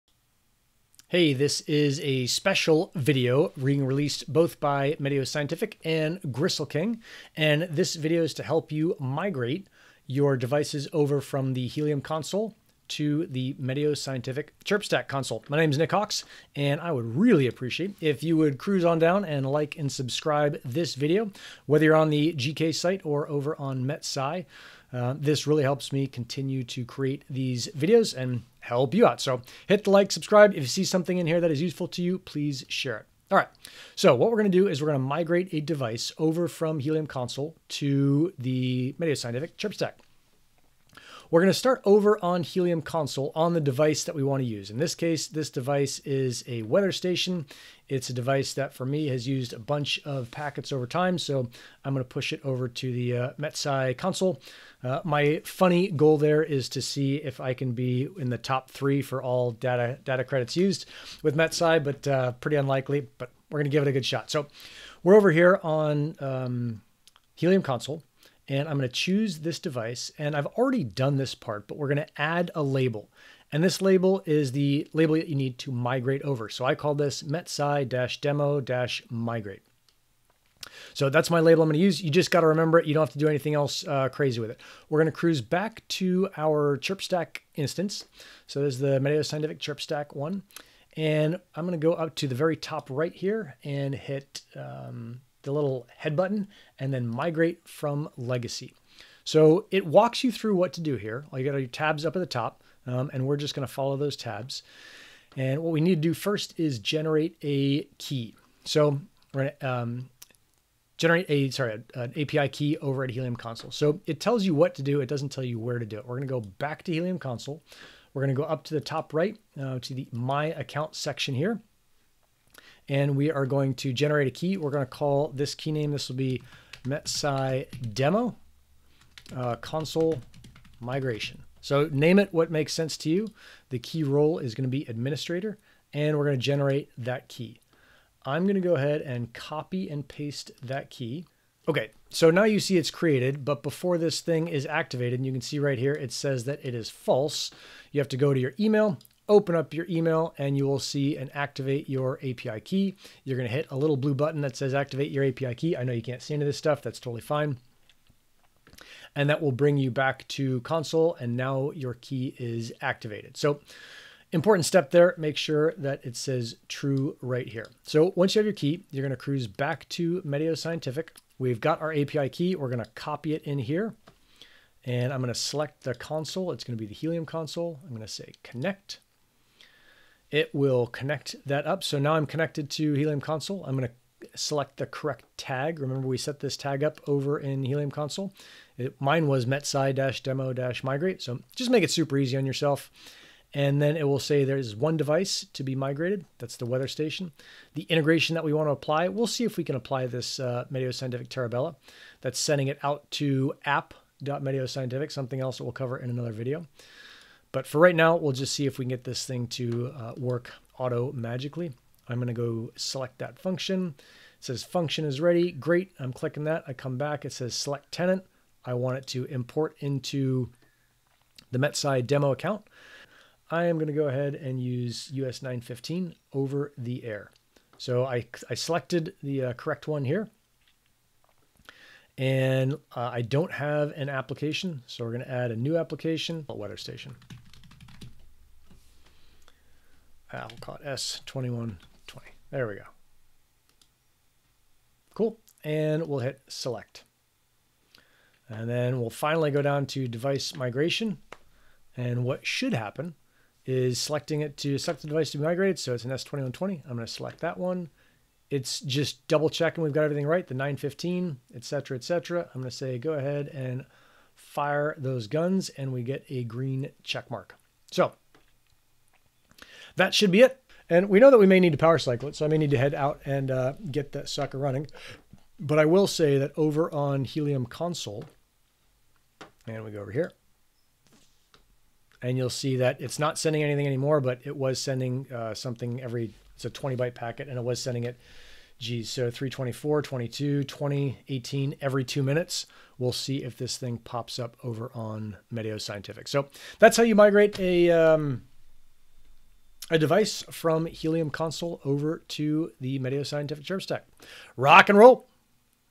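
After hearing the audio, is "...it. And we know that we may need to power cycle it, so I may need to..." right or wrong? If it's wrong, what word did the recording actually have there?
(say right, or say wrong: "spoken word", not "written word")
right.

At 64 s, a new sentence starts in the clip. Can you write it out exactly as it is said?
So we're over here on um, Helium console and I'm going to choose this device.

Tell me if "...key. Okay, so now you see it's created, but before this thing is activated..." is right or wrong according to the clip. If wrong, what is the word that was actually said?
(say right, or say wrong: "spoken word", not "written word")
right.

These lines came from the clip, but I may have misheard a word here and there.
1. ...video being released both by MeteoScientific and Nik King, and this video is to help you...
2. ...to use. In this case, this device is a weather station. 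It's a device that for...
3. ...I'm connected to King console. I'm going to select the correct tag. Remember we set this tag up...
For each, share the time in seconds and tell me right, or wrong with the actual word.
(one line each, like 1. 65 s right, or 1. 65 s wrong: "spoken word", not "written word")
1. 2 s wrong: "Gristle", not "Nik"
2. 44 s right
3. 182 s wrong: "Helium", not "King".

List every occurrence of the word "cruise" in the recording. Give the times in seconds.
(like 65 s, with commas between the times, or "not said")
18 s, 85 s, 169 s.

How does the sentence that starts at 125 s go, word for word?
This will be metsci demo uh, console migration.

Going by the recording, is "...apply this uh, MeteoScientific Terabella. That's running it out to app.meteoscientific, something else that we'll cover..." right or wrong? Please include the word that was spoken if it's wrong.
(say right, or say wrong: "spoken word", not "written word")
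wrong: "sending", not "running".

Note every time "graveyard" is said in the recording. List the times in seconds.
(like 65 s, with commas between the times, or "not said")
not said.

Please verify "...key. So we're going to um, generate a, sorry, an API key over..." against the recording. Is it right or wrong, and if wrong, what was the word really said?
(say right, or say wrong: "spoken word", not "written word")
right.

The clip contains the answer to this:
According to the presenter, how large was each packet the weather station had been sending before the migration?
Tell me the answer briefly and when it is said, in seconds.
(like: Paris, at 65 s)
20 bytes, at 286 s.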